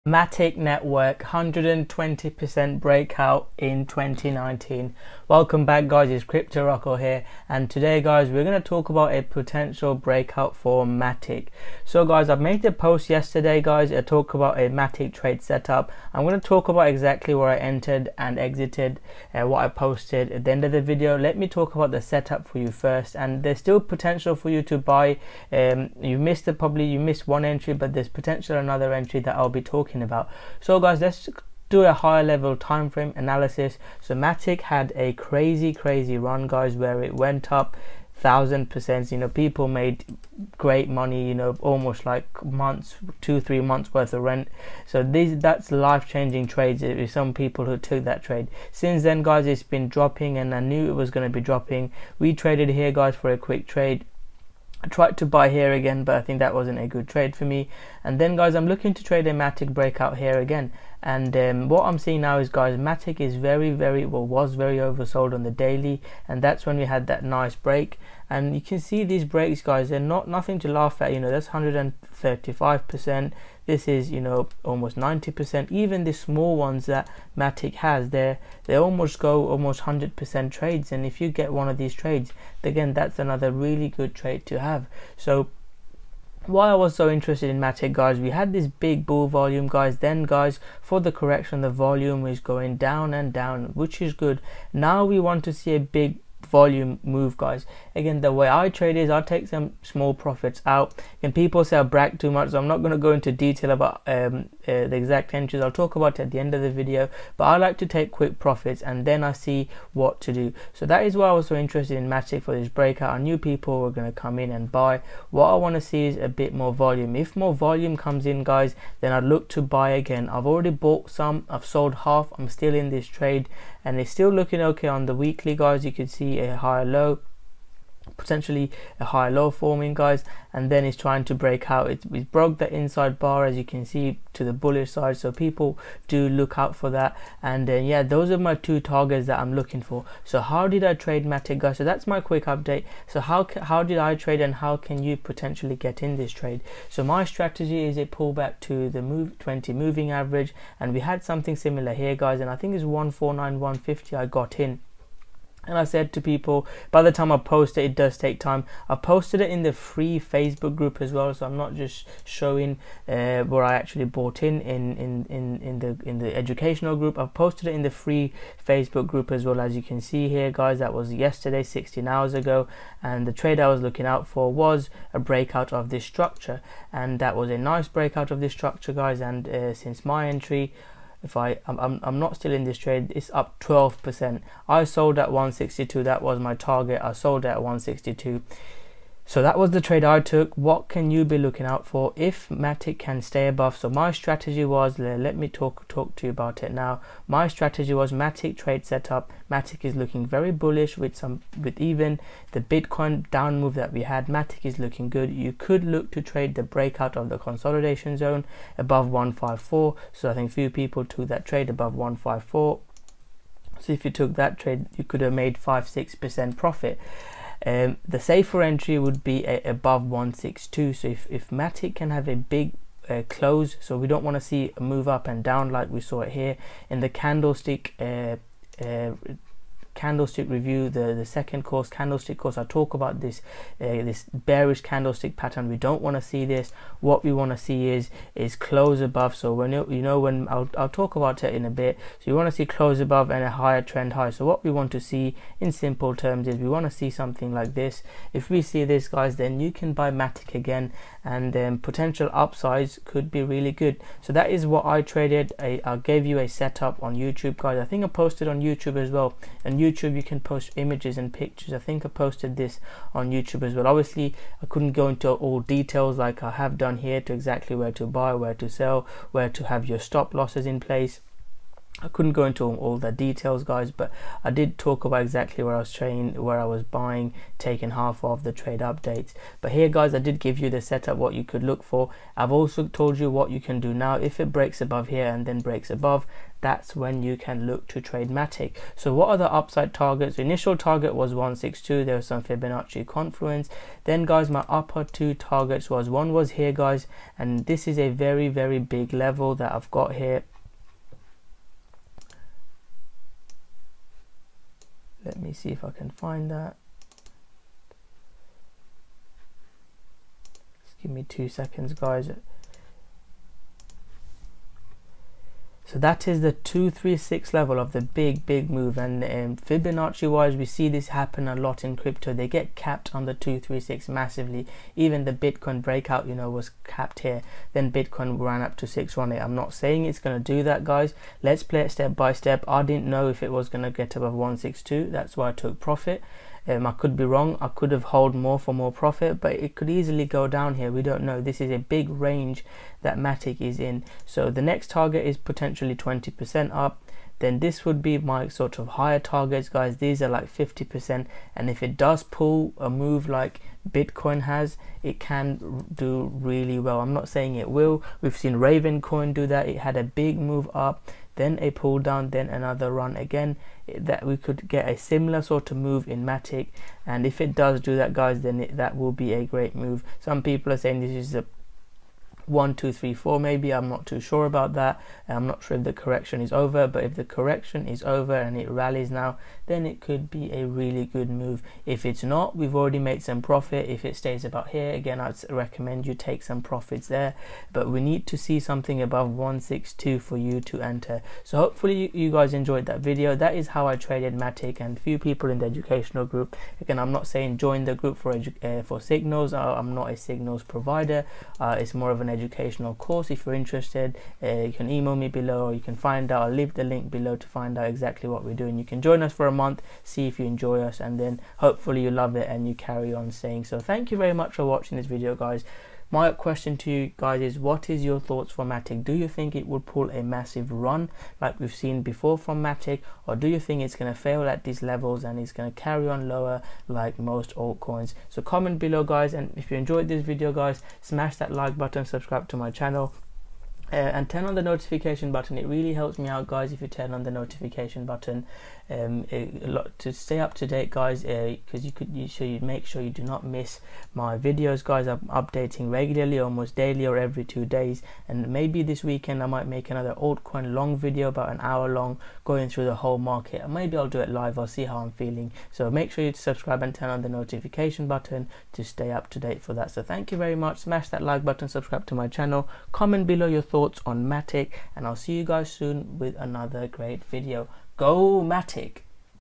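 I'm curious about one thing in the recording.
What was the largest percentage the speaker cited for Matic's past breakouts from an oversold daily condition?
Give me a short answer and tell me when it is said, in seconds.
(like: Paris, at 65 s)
135%, at 71 s.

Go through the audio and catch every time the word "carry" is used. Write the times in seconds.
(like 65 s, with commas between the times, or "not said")
412 s, 425 s.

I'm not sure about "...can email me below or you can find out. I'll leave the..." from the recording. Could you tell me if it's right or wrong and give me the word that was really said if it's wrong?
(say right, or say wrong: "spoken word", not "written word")
right.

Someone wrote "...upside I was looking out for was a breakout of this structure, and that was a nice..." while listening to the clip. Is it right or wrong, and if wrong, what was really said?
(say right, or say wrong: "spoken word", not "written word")
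wrong: "trade", not "upside".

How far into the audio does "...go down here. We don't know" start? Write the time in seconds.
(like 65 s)
340 s.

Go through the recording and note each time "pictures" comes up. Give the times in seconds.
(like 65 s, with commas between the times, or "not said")
261 s.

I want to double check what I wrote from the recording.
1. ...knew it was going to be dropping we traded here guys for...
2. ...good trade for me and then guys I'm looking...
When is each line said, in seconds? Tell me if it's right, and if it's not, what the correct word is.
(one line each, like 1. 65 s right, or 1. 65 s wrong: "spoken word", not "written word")
1. 50 s right
2. 56 s right.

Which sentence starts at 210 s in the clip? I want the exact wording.
So I think few people took that trade above 154.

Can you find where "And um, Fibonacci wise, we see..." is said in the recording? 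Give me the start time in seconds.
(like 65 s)
318 s.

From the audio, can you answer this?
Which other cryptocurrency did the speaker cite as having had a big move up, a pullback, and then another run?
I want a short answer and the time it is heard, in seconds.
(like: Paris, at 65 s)
Raven Coin, at 358 s.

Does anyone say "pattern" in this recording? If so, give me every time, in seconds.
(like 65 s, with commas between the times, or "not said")
235 s.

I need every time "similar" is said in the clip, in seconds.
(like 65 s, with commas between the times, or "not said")
151 s, 364 s.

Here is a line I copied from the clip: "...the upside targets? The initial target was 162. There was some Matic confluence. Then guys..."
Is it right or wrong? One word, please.
wrong.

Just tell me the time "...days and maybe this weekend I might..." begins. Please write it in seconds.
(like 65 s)
447 s.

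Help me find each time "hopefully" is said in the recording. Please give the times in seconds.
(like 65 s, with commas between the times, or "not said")
391 s, 411 s.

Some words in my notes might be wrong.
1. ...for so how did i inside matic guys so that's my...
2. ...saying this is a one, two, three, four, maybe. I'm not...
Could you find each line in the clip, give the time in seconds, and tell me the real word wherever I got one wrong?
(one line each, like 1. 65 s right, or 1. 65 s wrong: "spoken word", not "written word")
1. 139 s wrong: "trade", not "inside"
2. 370 s right.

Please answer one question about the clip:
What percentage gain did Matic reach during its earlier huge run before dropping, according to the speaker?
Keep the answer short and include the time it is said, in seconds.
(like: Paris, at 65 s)
1000%, at 38 s.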